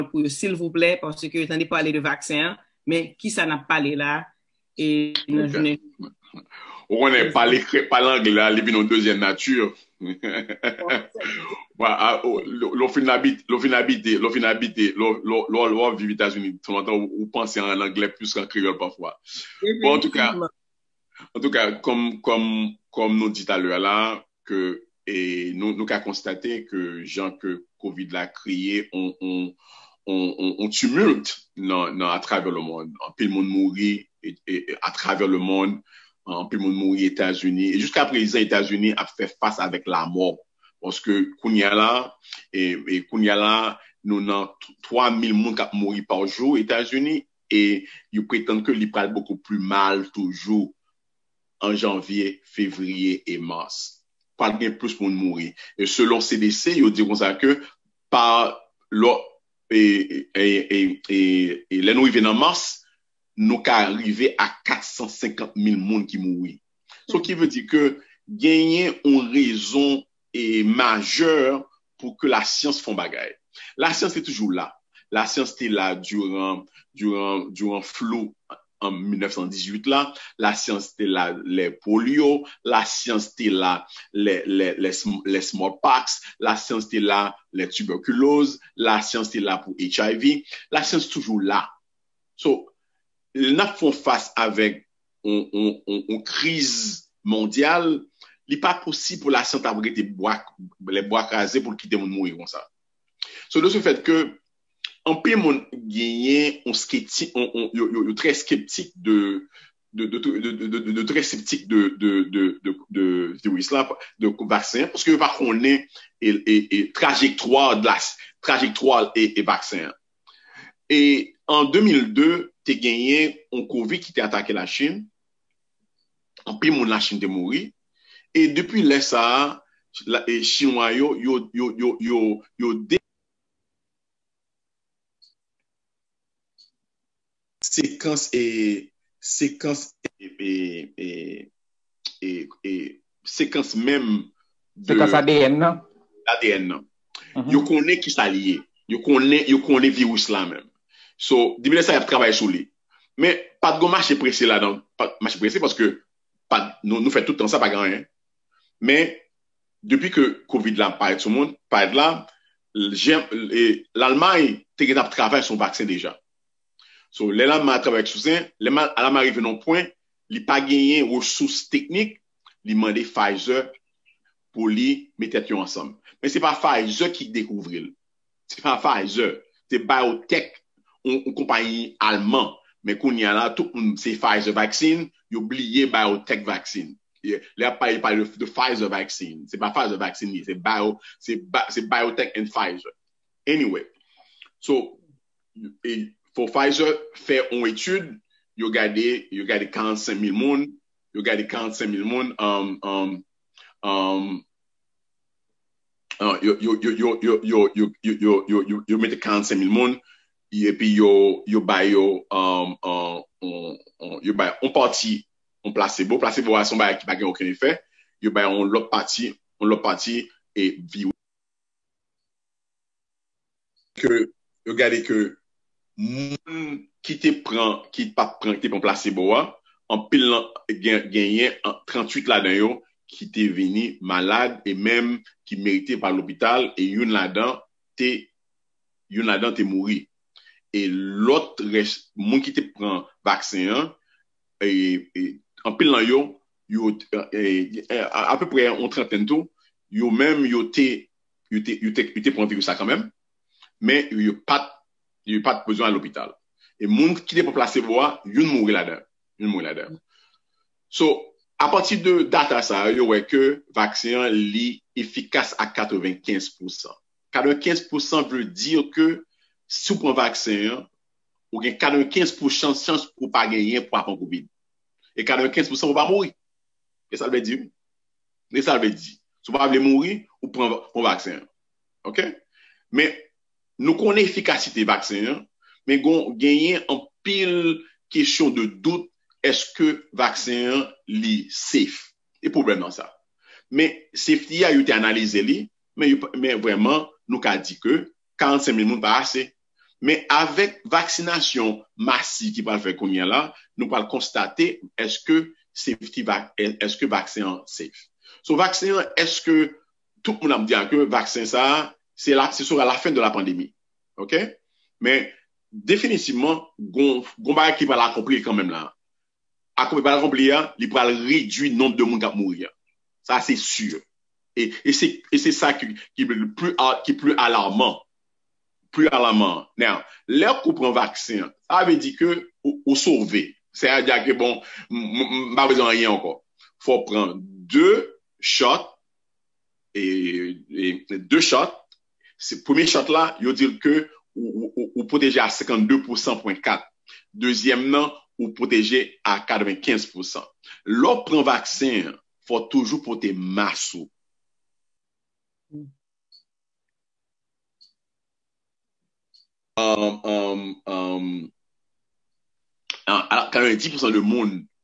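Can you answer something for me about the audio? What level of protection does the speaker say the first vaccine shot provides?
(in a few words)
52.4%.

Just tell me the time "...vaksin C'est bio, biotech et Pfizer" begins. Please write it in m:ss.
3:09.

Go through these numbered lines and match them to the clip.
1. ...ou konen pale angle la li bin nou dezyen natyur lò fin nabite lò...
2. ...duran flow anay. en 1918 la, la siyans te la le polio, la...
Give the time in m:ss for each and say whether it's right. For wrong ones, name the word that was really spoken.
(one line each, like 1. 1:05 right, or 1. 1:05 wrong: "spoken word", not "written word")
1. 0:06 right
2. 1:15 right.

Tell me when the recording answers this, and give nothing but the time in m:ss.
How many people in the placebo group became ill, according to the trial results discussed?
3:51.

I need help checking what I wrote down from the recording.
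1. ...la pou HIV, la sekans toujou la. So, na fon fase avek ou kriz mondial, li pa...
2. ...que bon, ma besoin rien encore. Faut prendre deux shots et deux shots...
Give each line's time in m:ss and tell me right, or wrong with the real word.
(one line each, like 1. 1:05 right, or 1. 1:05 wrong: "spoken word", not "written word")
1. 1:29 wrong: "siyans", not "sekans"
2. 5:34 right.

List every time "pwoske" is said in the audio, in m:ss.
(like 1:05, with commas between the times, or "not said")
0:40, 1:54.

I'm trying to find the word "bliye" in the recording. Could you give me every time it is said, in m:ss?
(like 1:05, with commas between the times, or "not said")
3:05.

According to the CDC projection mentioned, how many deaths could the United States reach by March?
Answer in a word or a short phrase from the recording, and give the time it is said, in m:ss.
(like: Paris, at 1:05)
450,000, at 1:04.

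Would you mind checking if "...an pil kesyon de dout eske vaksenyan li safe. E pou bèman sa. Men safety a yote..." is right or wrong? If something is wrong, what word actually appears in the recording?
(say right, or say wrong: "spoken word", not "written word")
right.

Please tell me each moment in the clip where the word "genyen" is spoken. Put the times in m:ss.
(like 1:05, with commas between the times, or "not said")
1:08, 1:45, 2:02, 2:50, 3:51, 4:33.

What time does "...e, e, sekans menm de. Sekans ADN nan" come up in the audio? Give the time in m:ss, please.
2:22.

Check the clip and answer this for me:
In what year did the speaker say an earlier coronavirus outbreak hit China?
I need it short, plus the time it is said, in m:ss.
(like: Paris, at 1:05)
2002, at 2:01.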